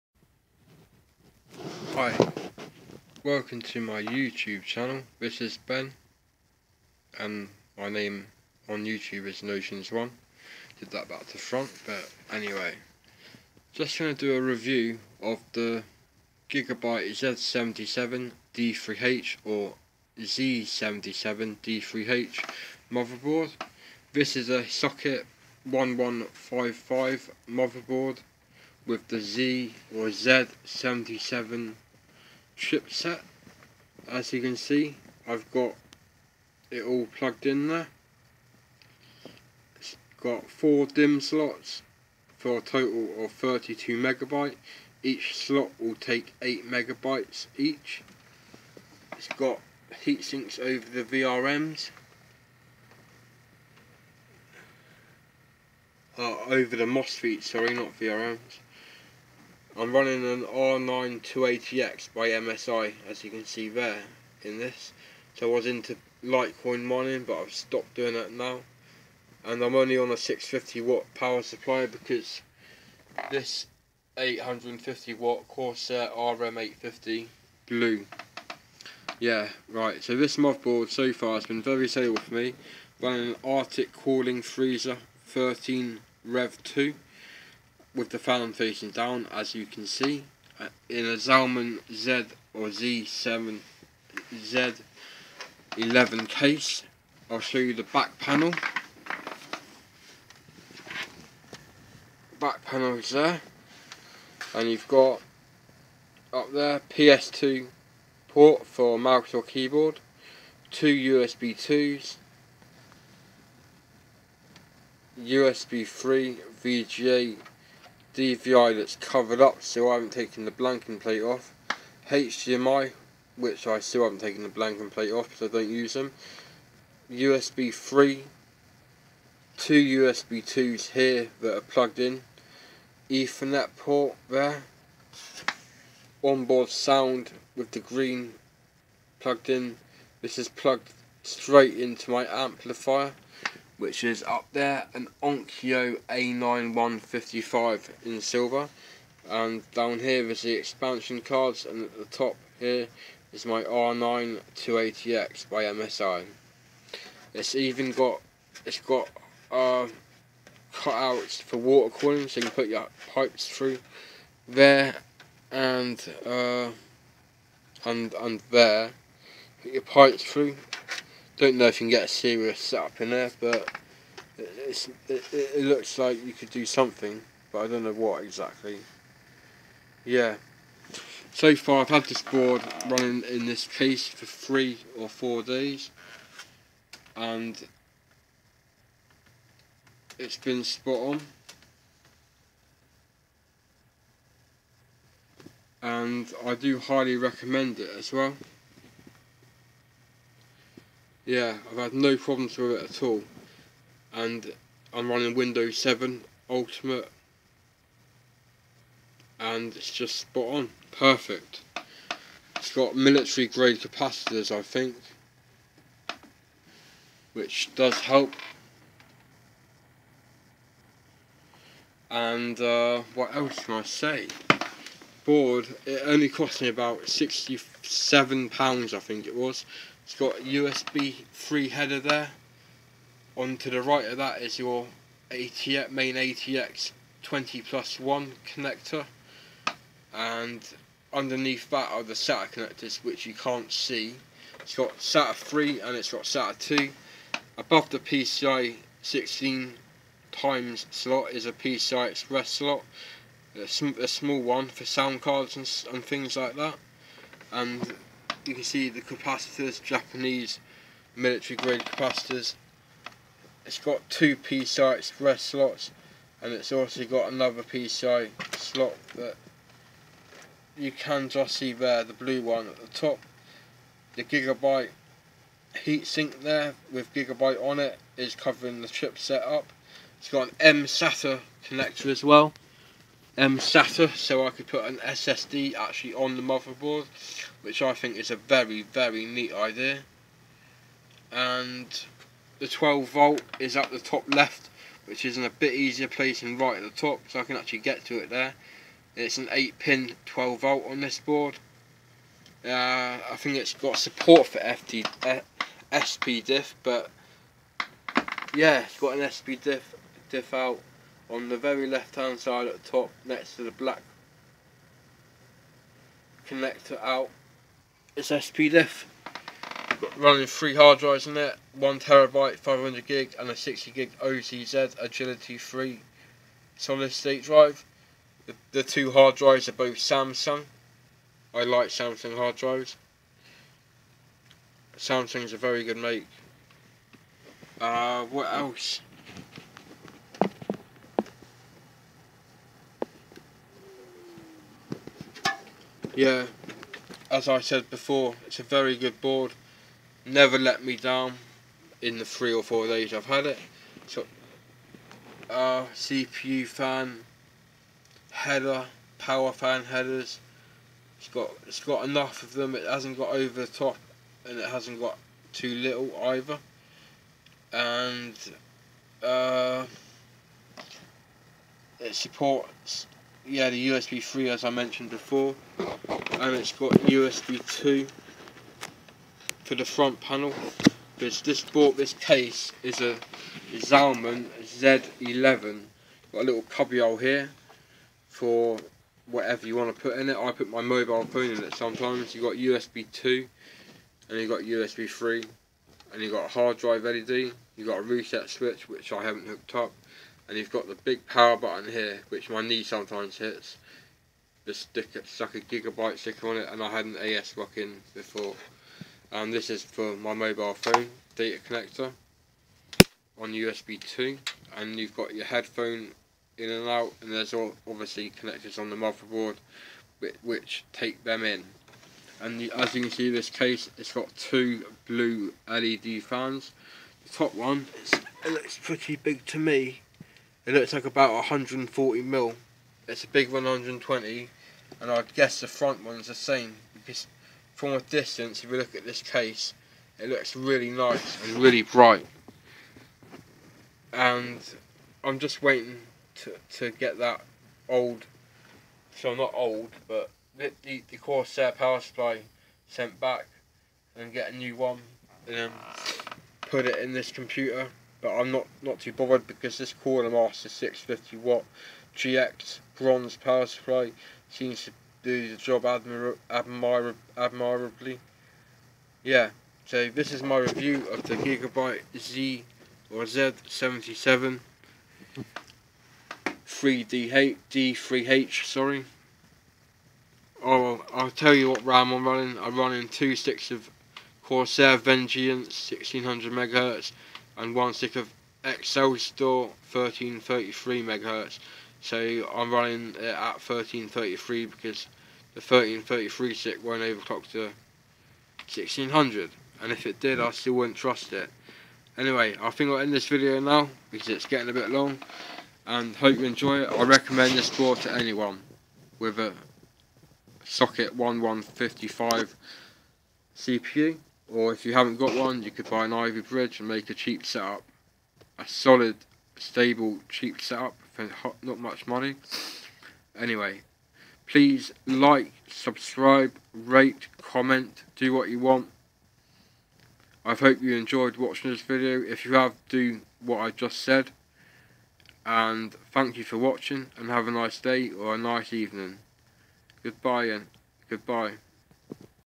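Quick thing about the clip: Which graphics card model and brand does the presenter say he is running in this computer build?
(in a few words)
R9 280X by MSI.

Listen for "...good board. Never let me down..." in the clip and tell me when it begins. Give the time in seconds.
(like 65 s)
348 s.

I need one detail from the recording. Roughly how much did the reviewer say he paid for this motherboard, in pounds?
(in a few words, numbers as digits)
£67.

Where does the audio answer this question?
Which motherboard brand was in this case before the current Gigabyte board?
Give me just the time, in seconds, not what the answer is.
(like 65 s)
407 s.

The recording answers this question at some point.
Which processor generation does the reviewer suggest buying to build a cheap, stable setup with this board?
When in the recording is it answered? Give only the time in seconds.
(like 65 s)
516 s.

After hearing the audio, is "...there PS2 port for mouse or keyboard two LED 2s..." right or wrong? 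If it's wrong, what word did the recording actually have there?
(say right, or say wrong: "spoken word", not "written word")
wrong: "USB", not "LED".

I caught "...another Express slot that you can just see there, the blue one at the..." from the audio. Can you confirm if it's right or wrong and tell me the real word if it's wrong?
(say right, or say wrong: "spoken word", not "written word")
wrong: "PCI", not "Express".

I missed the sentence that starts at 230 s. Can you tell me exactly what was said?
It's got a USB 3 header there.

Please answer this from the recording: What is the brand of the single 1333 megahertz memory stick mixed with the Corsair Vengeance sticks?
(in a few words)
Excel Store.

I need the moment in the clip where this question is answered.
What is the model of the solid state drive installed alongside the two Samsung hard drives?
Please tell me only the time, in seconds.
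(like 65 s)
324 s.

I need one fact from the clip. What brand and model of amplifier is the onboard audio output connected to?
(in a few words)
Onkyo A9155.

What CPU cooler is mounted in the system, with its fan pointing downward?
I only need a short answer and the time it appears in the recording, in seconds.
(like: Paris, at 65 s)
Arctic cooling freezer 13 Rev 2, at 83 s.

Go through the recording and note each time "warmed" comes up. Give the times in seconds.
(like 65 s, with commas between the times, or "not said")
not said.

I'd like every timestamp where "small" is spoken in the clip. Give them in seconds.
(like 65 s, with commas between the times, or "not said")
254 s.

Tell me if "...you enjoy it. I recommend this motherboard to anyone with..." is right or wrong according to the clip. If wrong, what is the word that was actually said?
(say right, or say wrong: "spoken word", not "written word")
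wrong: "board", not "motherboard".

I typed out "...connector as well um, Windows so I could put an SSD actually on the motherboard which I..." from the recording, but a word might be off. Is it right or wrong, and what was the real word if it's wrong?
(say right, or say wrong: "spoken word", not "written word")
wrong: "SATA", not "Windows".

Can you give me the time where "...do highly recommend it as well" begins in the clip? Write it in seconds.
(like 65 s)
196 s.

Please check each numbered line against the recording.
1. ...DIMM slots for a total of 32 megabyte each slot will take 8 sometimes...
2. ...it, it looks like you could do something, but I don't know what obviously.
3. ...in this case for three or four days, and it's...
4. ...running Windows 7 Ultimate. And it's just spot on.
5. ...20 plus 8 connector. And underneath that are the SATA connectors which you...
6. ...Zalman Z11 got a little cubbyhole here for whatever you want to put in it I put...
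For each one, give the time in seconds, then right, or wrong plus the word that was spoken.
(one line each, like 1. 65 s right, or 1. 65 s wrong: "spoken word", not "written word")
1. 40 s wrong: "megabytes", not "sometimes"
2. 174 s wrong: "exactly", not "obviously"
3. 183 s right
4. 205 s right
5. 237 s wrong: "1", not "8"
6. 383 s right.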